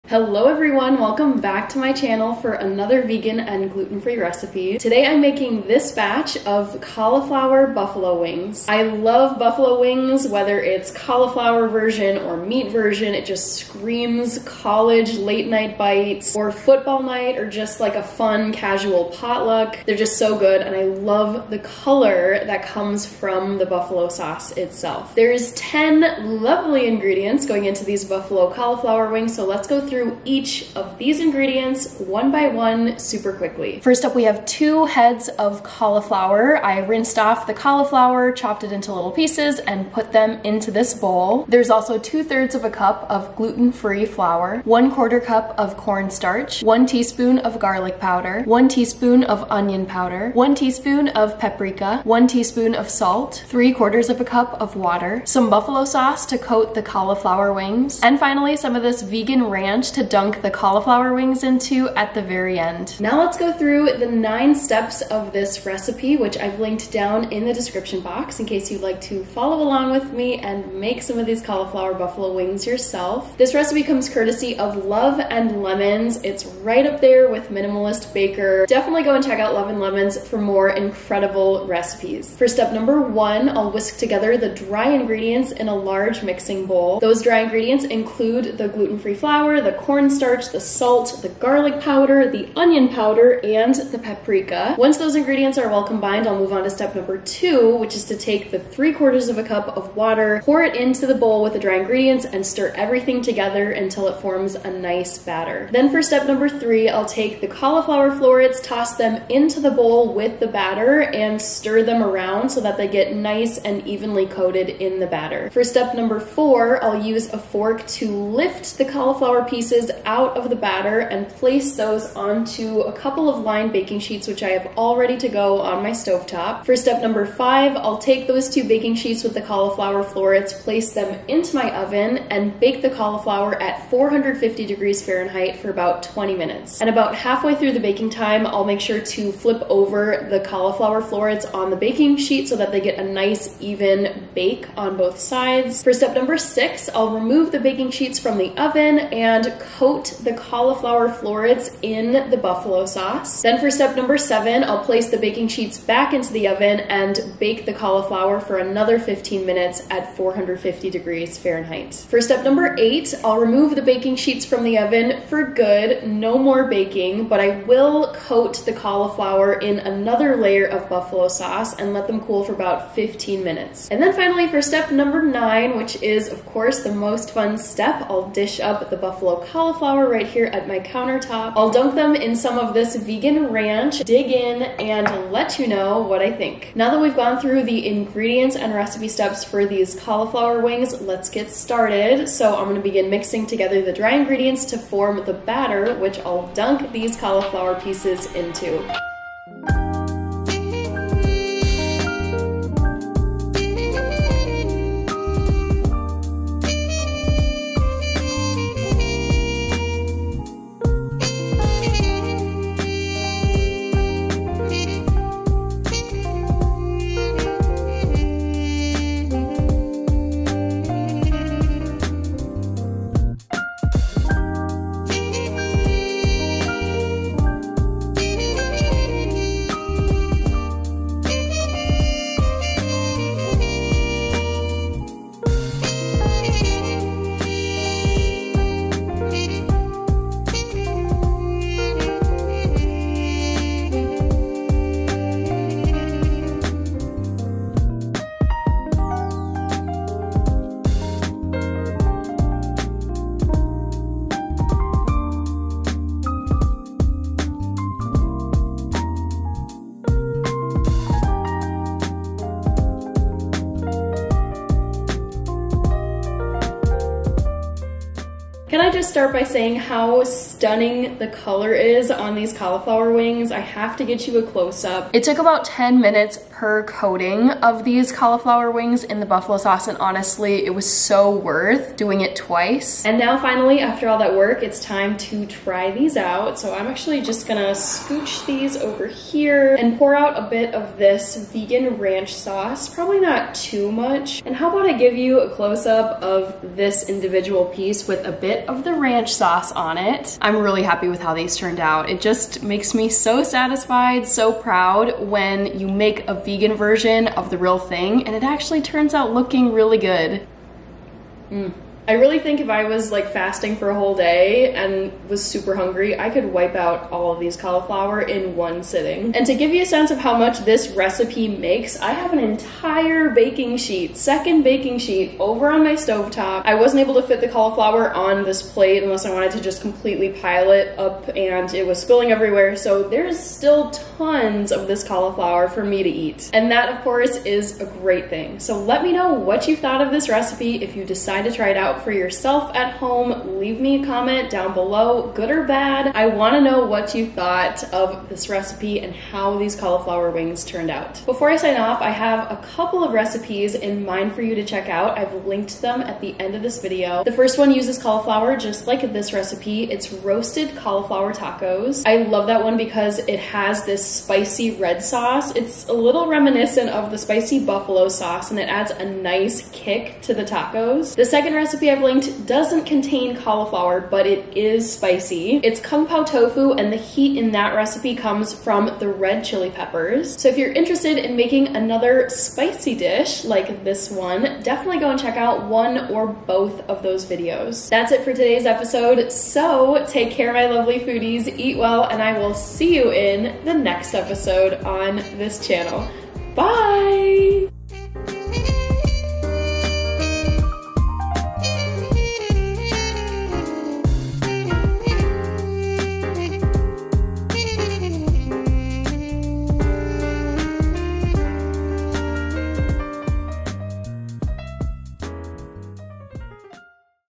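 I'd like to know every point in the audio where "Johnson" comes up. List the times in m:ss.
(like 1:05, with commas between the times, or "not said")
not said.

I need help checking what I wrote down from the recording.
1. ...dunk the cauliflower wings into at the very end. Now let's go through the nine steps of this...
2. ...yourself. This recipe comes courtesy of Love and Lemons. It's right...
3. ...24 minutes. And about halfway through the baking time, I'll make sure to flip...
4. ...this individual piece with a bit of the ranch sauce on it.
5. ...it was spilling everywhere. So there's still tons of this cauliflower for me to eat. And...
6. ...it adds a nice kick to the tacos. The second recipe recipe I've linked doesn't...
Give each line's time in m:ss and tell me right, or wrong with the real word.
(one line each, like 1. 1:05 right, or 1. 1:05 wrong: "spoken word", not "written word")
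1. 1:00 right
2. 1:12 right
3. 2:16 wrong: "20", not "24"
4. 4:56 right
5. 5:31 right
6. 6:08 right.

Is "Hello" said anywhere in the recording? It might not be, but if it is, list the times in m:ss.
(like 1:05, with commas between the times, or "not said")
0:00.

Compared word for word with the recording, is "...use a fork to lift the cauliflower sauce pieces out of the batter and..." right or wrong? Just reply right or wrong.
wrong.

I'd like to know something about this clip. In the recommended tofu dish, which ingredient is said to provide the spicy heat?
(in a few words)
Red chili peppers.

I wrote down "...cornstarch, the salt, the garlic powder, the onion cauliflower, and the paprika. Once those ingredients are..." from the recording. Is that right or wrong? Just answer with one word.
wrong.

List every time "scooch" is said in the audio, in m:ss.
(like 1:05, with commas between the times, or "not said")
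4:47.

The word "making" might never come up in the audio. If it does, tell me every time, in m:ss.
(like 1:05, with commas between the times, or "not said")
0:05, 6:21.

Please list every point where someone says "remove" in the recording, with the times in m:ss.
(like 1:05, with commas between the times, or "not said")
2:27, 2:43.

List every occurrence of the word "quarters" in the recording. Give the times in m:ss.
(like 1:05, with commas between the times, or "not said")
0:44, 0:53, 1:38.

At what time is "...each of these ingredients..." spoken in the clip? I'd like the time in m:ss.
0:30.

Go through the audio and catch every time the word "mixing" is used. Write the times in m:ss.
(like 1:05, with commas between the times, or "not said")
1:26, 3:13.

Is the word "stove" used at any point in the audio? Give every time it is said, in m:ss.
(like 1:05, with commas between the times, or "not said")
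2:05, 5:25.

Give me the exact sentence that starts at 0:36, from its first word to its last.
I rinsed off the cauliflower, chopped it into little pieces, and put them into this bowl.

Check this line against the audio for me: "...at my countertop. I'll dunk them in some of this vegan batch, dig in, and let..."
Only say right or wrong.
wrong.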